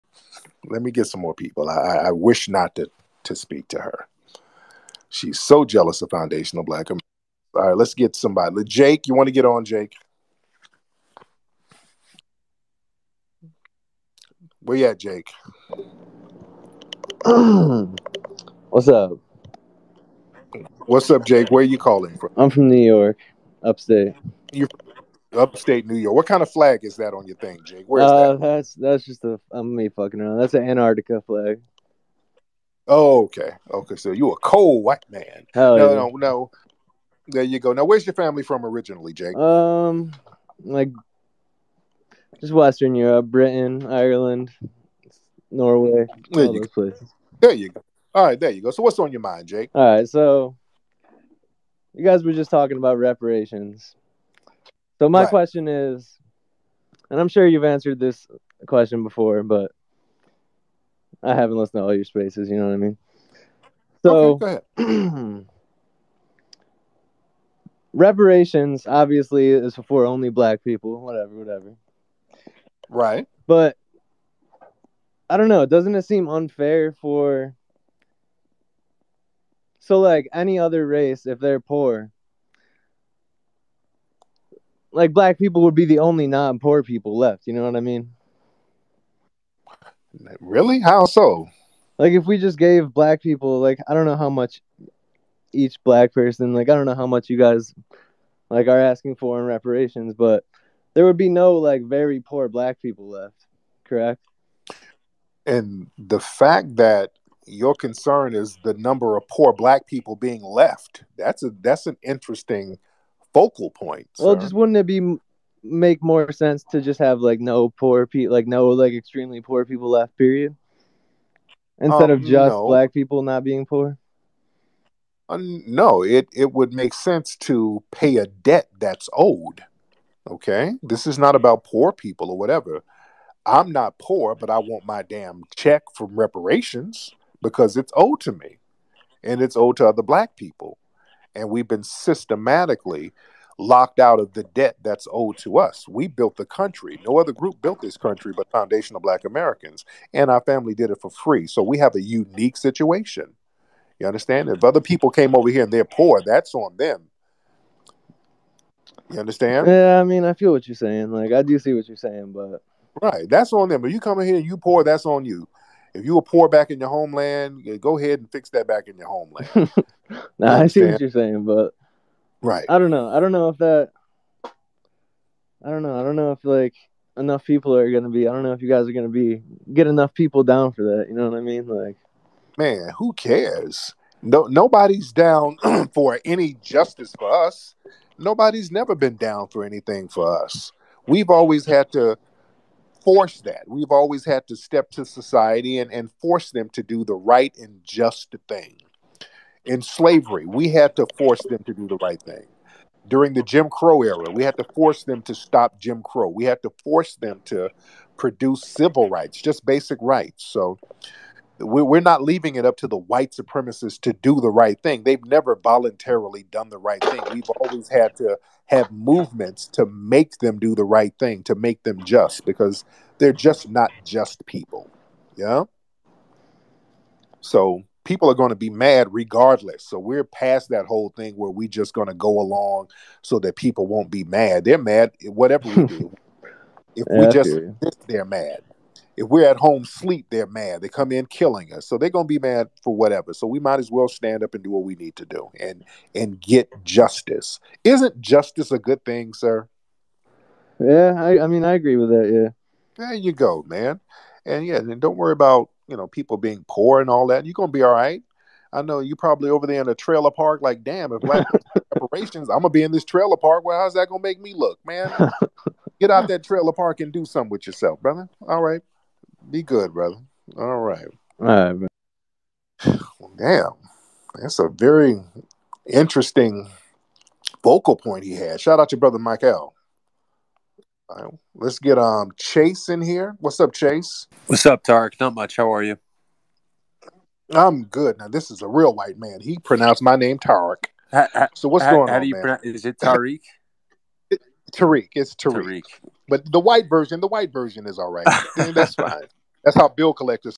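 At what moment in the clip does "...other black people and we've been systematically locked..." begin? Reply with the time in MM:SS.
02:19.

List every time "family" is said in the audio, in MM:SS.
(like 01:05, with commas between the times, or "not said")
00:38, 02:30.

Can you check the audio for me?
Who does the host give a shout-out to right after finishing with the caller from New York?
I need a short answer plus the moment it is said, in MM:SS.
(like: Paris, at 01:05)
Mike L, at 04:39.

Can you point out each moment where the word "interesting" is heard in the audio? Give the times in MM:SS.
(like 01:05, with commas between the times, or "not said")
01:52, 04:35.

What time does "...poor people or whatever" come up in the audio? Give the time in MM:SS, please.
02:11.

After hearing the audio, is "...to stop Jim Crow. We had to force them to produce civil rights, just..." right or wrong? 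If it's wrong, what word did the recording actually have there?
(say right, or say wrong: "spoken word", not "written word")
right.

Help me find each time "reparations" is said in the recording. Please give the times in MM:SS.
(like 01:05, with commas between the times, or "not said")
00:52, 01:07, 01:39, 02:16, 04:22.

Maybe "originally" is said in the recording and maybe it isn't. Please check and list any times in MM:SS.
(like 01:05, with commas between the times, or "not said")
00:38.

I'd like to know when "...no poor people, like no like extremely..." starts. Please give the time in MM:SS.
01:57.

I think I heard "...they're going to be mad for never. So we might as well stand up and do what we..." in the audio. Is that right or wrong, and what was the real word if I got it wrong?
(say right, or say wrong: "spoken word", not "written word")
wrong: "whatever", not "never".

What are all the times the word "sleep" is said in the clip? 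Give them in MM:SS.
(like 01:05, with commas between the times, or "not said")
03:59.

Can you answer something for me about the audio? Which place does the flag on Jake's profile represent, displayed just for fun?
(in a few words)
Antarctica.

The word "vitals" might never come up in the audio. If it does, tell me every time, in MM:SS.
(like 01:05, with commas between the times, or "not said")
not said.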